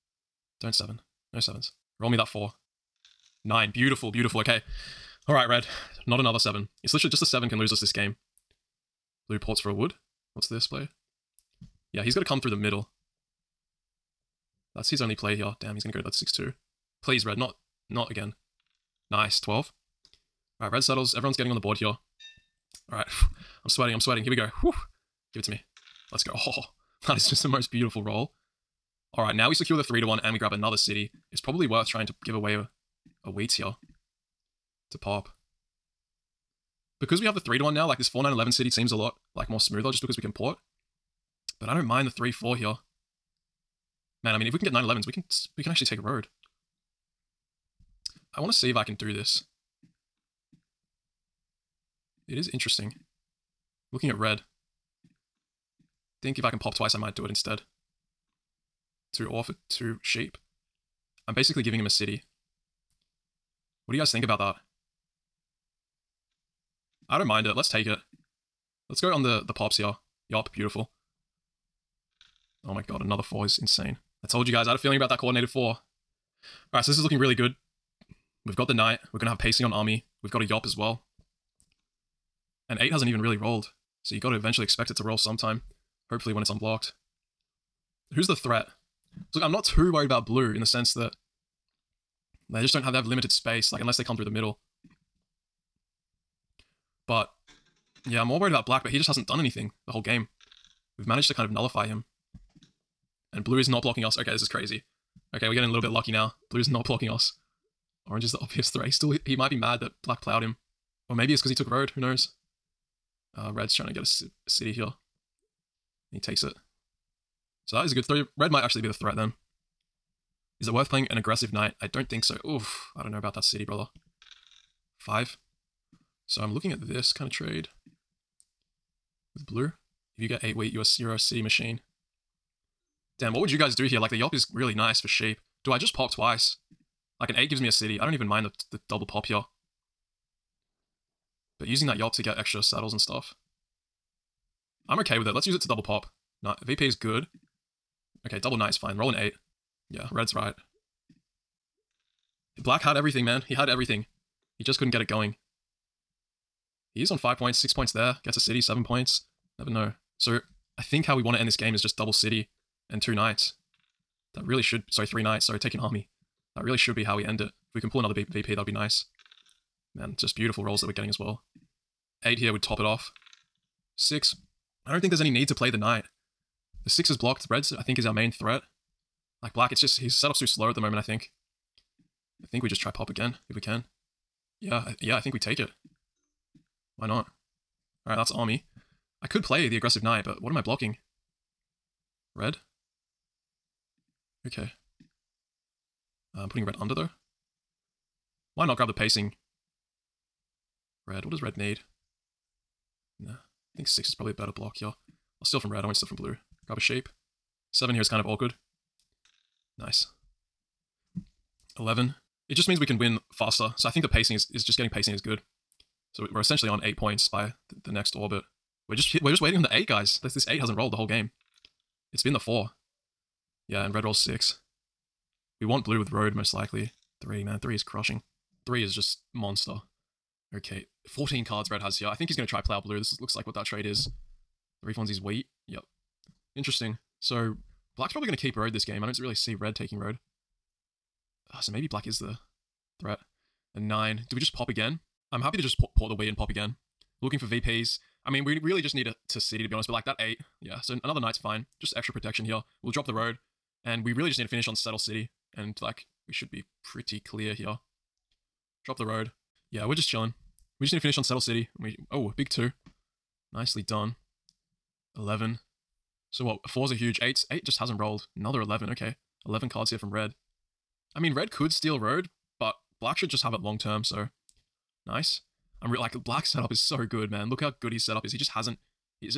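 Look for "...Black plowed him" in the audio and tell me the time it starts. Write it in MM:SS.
01:50.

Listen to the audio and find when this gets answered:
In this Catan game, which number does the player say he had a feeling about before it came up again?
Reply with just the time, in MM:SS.
01:15.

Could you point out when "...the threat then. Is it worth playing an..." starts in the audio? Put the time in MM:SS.
01:58.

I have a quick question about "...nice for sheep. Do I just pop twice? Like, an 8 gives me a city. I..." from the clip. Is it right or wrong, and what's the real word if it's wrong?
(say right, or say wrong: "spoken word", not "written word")
right.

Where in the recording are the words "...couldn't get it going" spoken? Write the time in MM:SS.
02:34.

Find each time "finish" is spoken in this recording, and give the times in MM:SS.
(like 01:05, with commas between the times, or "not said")
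04:14, 04:20.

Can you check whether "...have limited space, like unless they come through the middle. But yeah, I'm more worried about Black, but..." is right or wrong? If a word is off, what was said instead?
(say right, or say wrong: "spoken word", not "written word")
right.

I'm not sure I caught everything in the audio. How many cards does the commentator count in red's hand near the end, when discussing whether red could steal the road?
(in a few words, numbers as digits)
11.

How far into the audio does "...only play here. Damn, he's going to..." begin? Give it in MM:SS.
00:15.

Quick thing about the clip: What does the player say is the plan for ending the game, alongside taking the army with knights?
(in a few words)
Double city.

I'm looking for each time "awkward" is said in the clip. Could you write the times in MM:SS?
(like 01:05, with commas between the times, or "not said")
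03:28.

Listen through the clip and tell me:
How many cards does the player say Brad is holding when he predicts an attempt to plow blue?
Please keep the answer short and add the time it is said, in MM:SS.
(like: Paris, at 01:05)
14, at 03:51.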